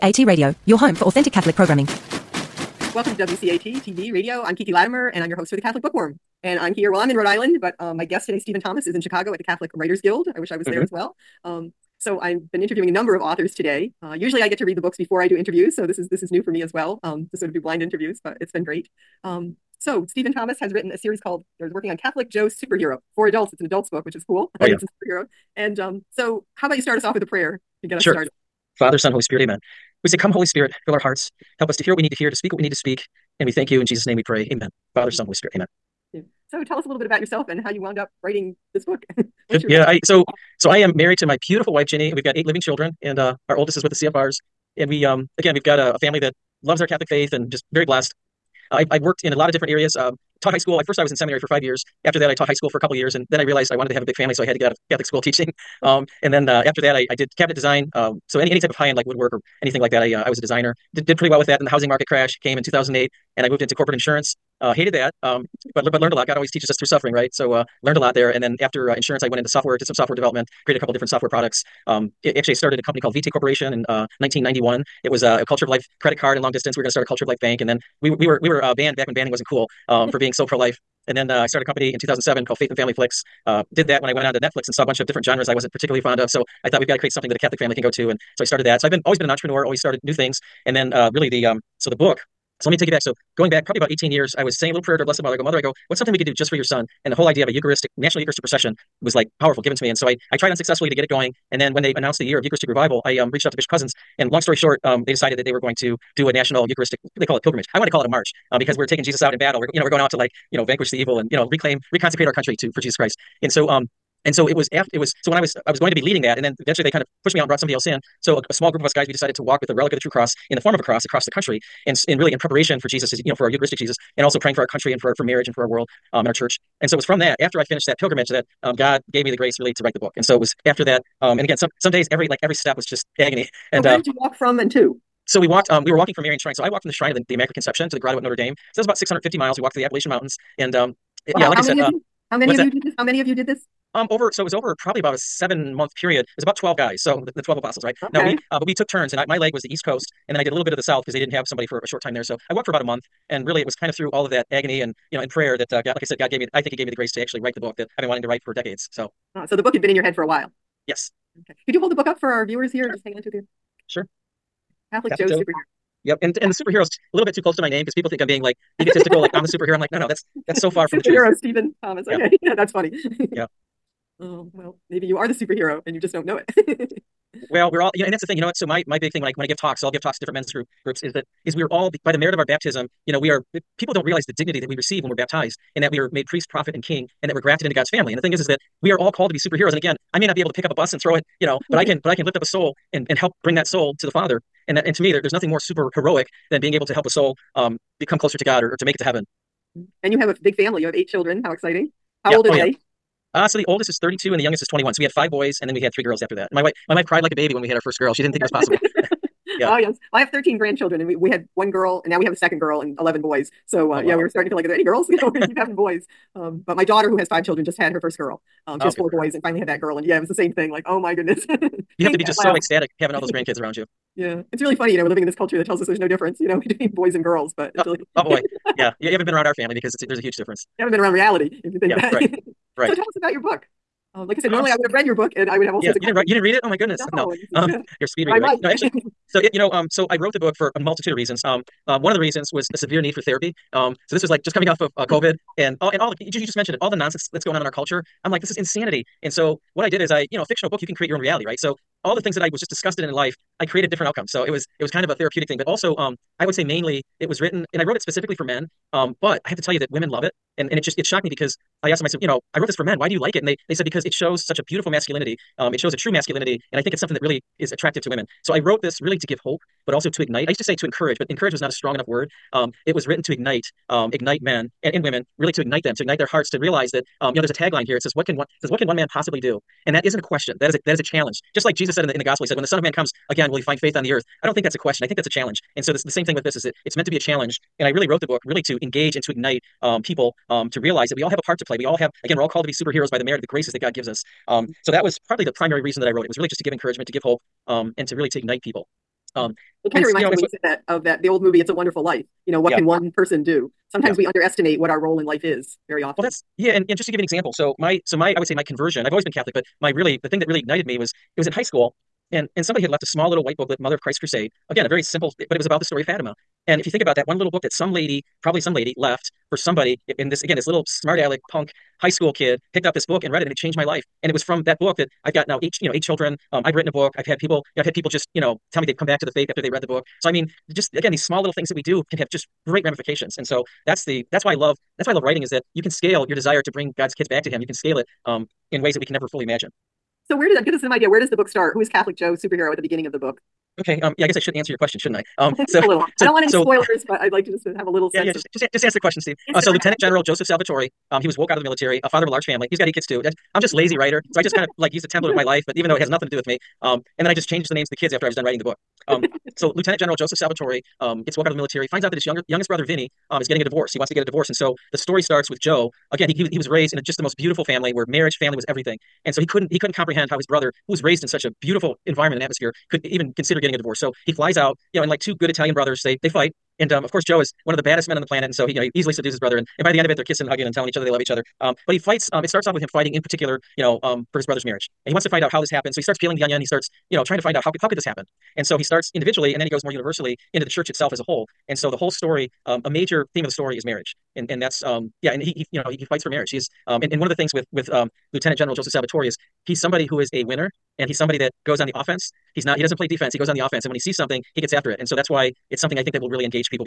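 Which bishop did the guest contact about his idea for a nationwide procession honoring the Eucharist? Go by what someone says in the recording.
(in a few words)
Bishop Cozzens.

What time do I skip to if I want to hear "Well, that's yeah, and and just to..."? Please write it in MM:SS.
05:06.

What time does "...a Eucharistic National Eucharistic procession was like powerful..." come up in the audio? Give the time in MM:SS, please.
01:37.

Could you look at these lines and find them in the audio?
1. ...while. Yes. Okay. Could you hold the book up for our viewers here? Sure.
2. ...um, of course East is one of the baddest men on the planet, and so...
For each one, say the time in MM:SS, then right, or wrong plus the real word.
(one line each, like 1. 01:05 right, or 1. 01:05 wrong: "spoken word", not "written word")
1. 02:40 right
2. 06:16 wrong: "Joe", not "East".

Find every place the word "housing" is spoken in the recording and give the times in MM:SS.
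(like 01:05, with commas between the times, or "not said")
01:01.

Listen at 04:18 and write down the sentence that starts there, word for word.
Um, but I have to tell you that women love it, and and it just it shocked me because I asked them.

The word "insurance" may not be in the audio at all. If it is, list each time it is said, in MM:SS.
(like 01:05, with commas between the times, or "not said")
01:03, 01:08.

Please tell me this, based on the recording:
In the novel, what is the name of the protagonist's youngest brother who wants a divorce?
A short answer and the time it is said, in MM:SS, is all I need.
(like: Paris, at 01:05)
Vinny, at 06:02.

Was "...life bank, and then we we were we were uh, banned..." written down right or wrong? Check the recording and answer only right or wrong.
right.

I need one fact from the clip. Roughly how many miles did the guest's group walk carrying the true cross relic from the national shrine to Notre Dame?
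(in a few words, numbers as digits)
650.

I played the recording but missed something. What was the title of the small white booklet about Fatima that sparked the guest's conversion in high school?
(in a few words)
Mother of Christ Crusade.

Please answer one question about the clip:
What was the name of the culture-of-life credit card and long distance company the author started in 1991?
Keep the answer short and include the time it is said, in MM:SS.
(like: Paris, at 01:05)
Vitae Corporation, at 01:13.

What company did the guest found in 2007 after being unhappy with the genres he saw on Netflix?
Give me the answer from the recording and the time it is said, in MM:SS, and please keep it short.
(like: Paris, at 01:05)
Faith and Family Flicks, at 01:22.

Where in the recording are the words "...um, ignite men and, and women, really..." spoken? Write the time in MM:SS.
04:33.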